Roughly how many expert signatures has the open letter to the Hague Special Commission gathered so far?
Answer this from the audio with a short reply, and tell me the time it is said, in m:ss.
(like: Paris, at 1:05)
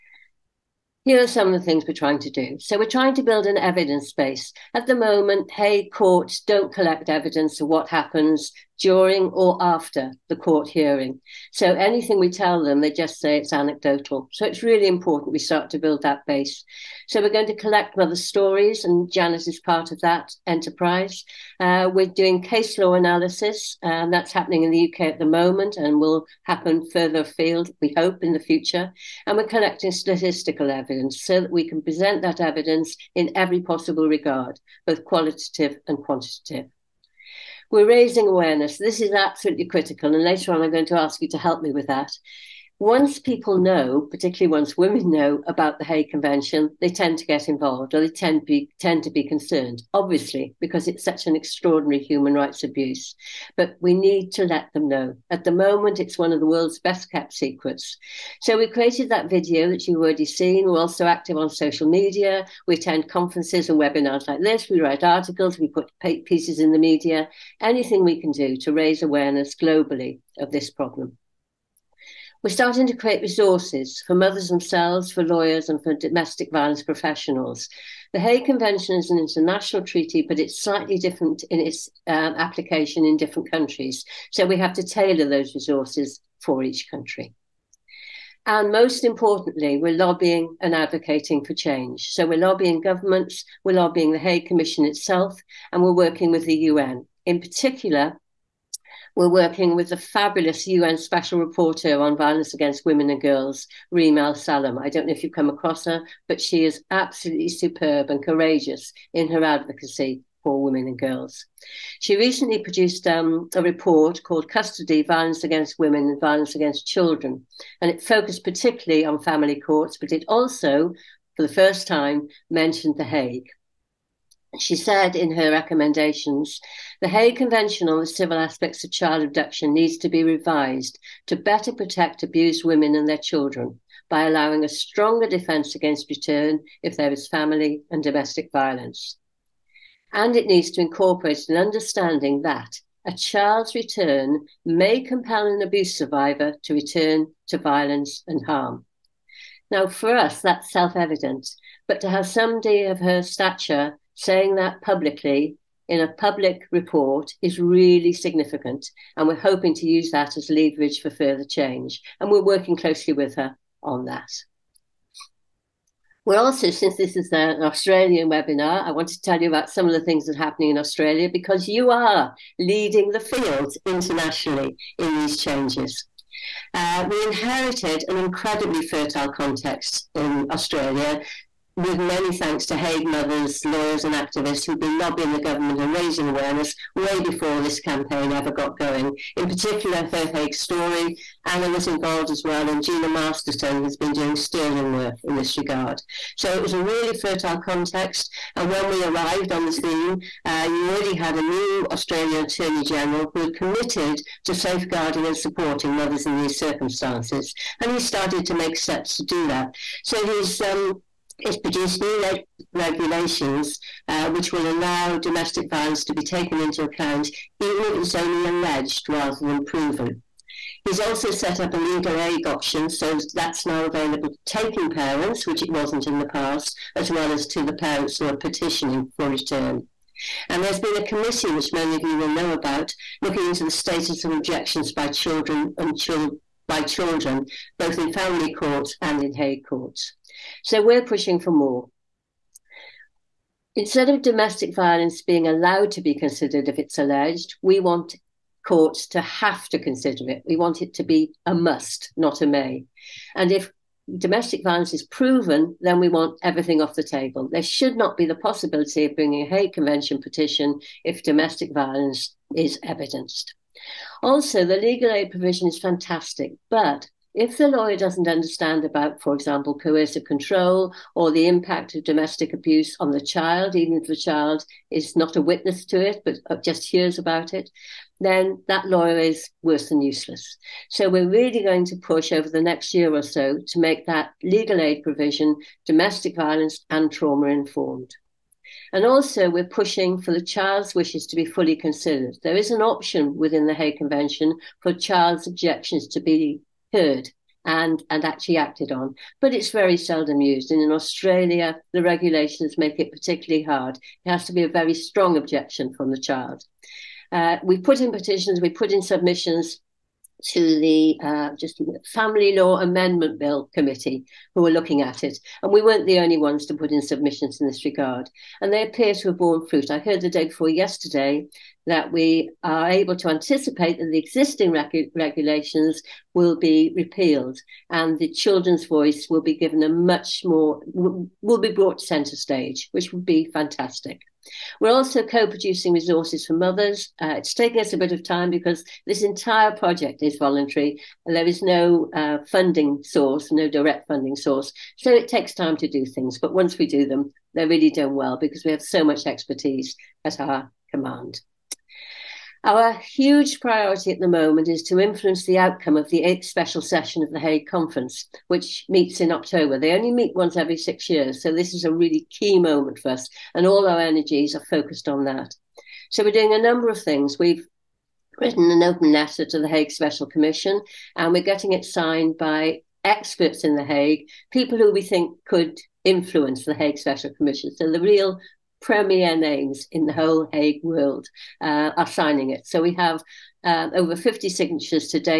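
Over 50, at 6:23.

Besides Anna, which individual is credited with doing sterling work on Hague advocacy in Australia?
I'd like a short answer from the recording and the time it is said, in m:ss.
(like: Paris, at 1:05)
Gina Masterton, at 3:12.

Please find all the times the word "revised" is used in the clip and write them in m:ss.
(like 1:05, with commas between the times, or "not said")
2:10.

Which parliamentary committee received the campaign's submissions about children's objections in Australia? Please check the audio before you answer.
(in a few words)
Family Law Amendment Bill Committee.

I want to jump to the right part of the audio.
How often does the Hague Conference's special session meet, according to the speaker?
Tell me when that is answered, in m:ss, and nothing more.
6:00.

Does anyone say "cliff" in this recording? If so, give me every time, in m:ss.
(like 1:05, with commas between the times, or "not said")
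not said.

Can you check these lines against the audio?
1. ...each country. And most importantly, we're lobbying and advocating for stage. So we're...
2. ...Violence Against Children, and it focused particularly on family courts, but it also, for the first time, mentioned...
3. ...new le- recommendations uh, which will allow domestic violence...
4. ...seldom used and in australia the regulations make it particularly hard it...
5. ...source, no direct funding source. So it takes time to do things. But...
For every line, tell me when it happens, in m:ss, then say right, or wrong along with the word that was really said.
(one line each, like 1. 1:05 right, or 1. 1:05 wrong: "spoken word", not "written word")
1. 1:26 wrong: "change", not "stage"
2. 1:56 right
3. 3:32 wrong: "regulations", not "recommendations"
4. 4:59 right
5. 5:43 right.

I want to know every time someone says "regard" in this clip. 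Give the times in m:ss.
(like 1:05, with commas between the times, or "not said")
0:34, 3:15, 5:17.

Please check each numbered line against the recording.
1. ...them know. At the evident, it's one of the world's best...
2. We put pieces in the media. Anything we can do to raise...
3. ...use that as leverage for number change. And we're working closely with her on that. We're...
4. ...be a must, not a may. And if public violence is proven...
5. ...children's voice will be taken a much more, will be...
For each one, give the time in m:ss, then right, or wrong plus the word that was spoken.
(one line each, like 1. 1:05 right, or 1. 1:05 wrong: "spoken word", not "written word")
1. 0:54 wrong: "moment", not "evident"
2. 1:05 right
3. 2:39 wrong: "further", not "number"
4. 4:11 wrong: "domestic", not "public"
5. 5:28 wrong: "given", not "taken".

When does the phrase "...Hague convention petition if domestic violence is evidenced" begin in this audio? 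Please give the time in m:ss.
4:19.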